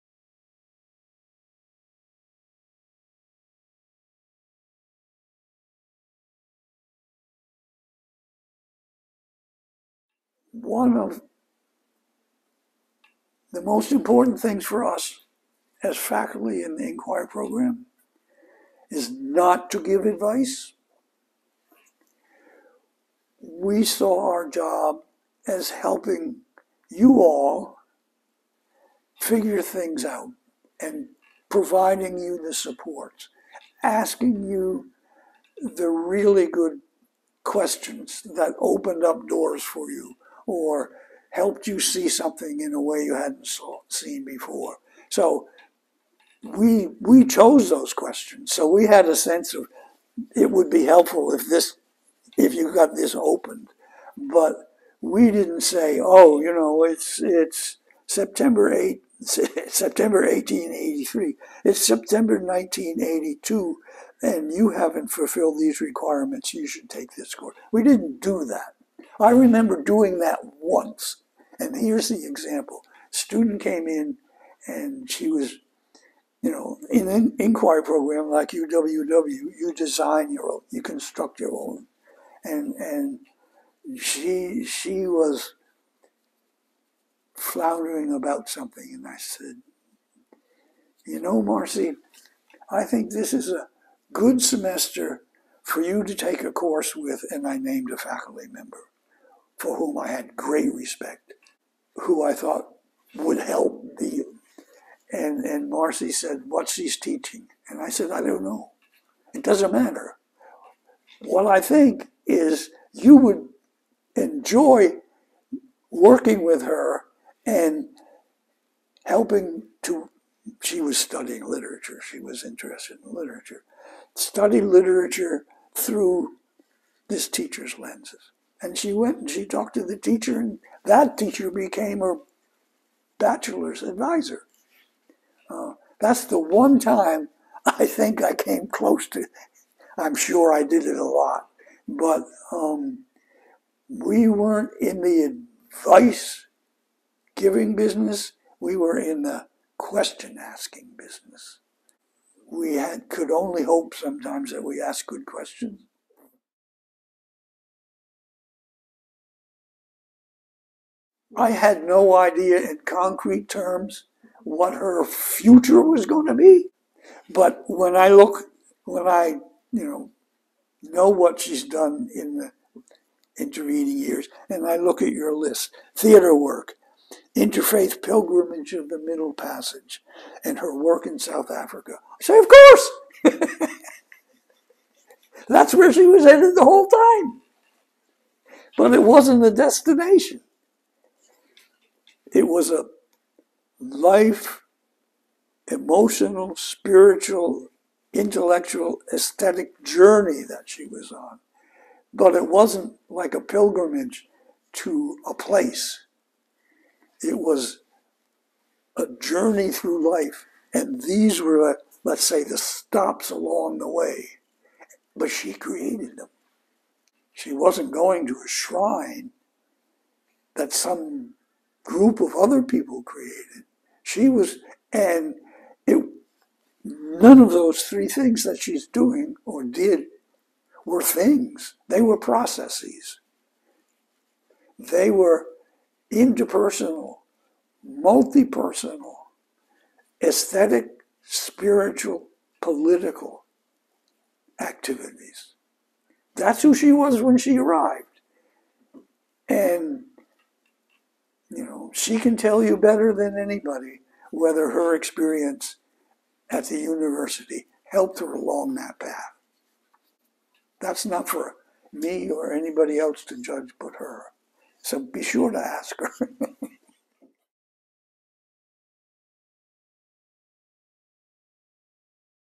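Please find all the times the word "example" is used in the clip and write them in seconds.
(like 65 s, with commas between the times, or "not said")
72 s.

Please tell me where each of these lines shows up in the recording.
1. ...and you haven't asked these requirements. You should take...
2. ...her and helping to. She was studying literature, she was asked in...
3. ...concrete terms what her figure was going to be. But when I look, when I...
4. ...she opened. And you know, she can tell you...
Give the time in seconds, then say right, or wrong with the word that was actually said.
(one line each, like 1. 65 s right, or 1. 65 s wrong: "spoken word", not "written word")
1. 64 s wrong: "fulfilled", not "asked"
2. 116 s wrong: "interested", not "asked"
3. 162 s wrong: "future", not "figure"
4. 247 s wrong: "arrived", not "opened".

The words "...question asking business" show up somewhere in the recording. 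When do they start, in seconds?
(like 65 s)
149 s.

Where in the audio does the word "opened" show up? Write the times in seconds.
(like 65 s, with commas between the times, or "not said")
38 s, 53 s.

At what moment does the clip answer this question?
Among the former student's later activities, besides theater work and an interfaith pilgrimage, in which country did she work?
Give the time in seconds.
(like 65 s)
181 s.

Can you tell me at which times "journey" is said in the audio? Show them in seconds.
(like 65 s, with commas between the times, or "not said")
199 s, 209 s.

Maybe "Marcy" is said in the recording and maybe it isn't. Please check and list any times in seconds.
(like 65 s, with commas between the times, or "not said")
91 s, 105 s.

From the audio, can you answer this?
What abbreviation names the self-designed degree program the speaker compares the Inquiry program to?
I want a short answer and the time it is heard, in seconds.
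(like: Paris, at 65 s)
UWW, at 78 s.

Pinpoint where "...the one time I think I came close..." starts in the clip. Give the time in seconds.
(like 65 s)
136 s.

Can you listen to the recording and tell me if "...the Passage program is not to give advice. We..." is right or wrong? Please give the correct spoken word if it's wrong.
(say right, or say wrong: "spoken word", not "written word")
wrong: "Inquiry", not "Passage".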